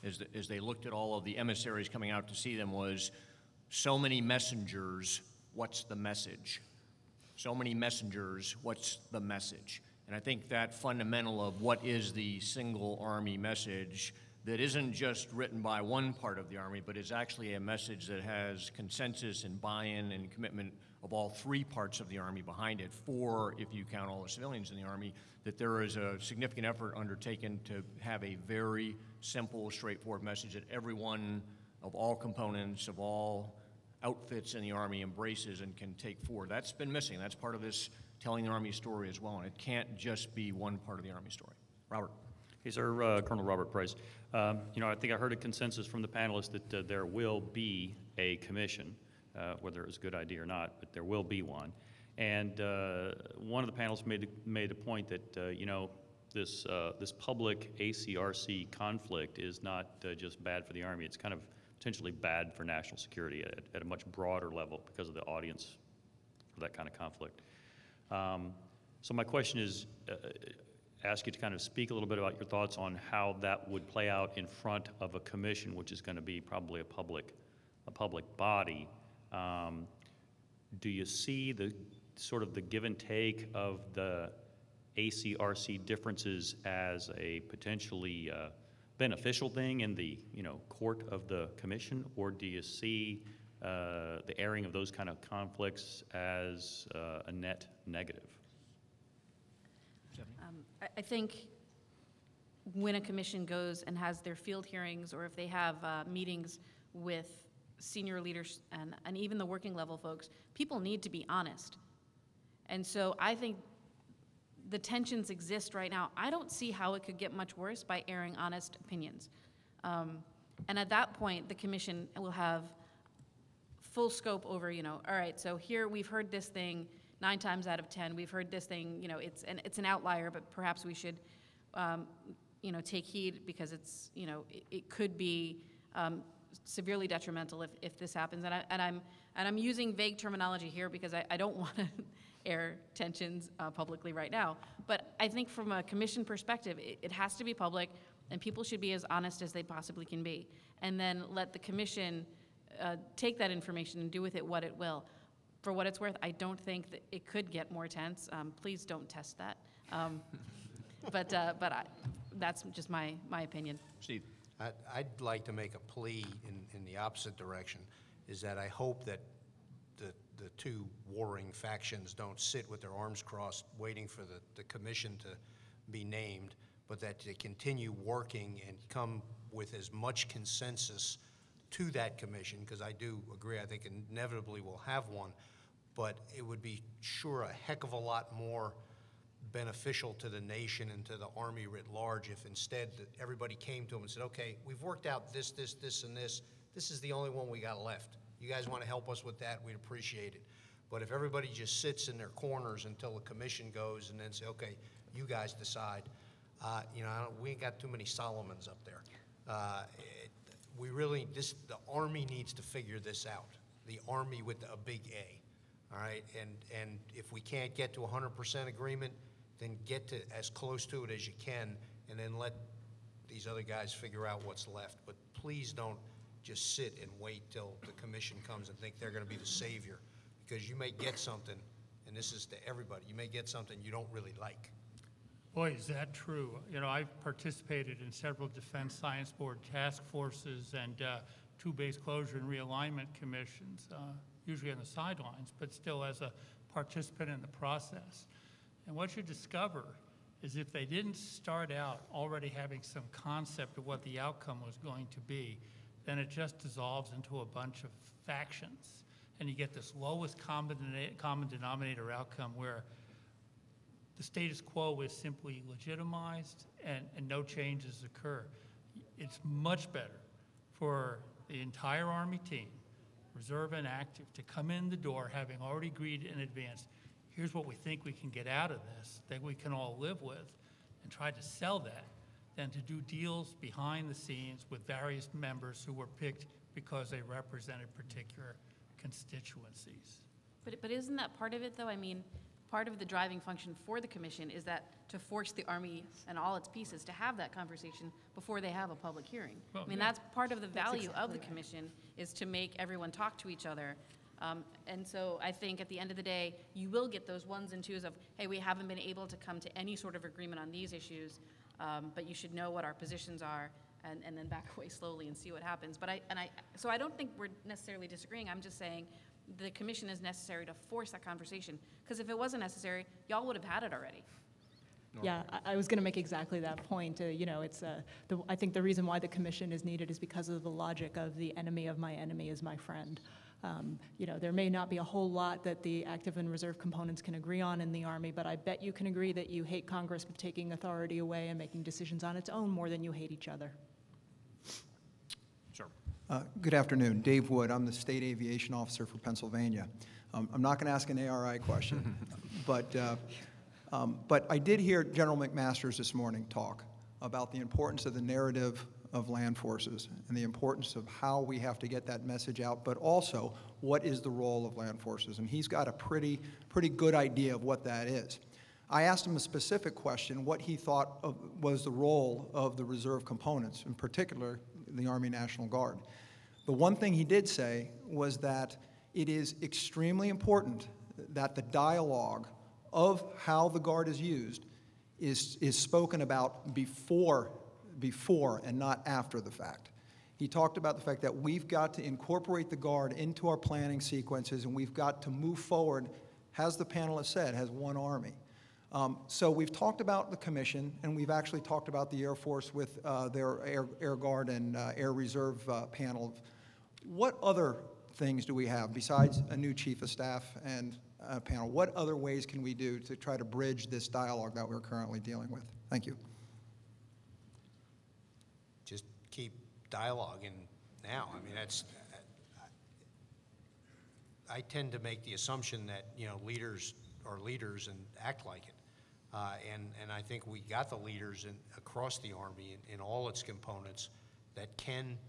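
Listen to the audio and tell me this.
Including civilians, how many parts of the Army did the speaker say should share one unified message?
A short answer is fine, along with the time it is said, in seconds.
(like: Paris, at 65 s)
4, at 23 s.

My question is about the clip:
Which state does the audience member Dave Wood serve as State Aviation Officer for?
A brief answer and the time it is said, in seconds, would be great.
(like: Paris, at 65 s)
Pennsylvania, at 349 s.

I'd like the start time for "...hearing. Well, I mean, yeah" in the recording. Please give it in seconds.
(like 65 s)
299 s.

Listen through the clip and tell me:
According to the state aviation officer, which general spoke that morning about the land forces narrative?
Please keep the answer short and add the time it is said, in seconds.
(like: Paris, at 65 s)
General McMaster, at 355 s.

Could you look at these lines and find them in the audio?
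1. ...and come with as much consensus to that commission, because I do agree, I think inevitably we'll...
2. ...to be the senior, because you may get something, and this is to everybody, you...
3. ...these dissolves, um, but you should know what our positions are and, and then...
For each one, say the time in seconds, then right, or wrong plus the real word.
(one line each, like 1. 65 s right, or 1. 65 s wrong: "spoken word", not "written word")
1. 178 s right
2. 229 s wrong: "savior", not "senior"
3. 310 s wrong: "issues", not "dissolves".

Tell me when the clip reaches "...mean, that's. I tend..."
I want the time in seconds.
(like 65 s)
421 s.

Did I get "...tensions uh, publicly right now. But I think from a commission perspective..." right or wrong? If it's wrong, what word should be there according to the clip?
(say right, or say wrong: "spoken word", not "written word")
right.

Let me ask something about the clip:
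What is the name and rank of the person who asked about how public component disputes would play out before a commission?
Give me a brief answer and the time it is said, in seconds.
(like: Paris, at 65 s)
Colonel Robert Price, at 43 s.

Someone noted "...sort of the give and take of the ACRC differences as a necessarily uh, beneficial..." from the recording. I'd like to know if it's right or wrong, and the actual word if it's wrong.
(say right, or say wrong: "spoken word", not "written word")
wrong: "potentially", not "necessarily".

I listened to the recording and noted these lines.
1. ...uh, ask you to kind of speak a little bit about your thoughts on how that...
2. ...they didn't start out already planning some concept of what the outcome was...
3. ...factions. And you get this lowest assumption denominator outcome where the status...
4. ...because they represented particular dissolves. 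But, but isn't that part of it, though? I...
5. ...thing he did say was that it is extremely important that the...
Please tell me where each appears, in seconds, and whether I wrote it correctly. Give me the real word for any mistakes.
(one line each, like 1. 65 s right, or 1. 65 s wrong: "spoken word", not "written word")
1. 70 s right
2. 250 s wrong: "having", not "planning"
3. 258 s wrong: "common", not "assumption"
4. 286 s wrong: "constituencies", not "dissolves"
5. 376 s right.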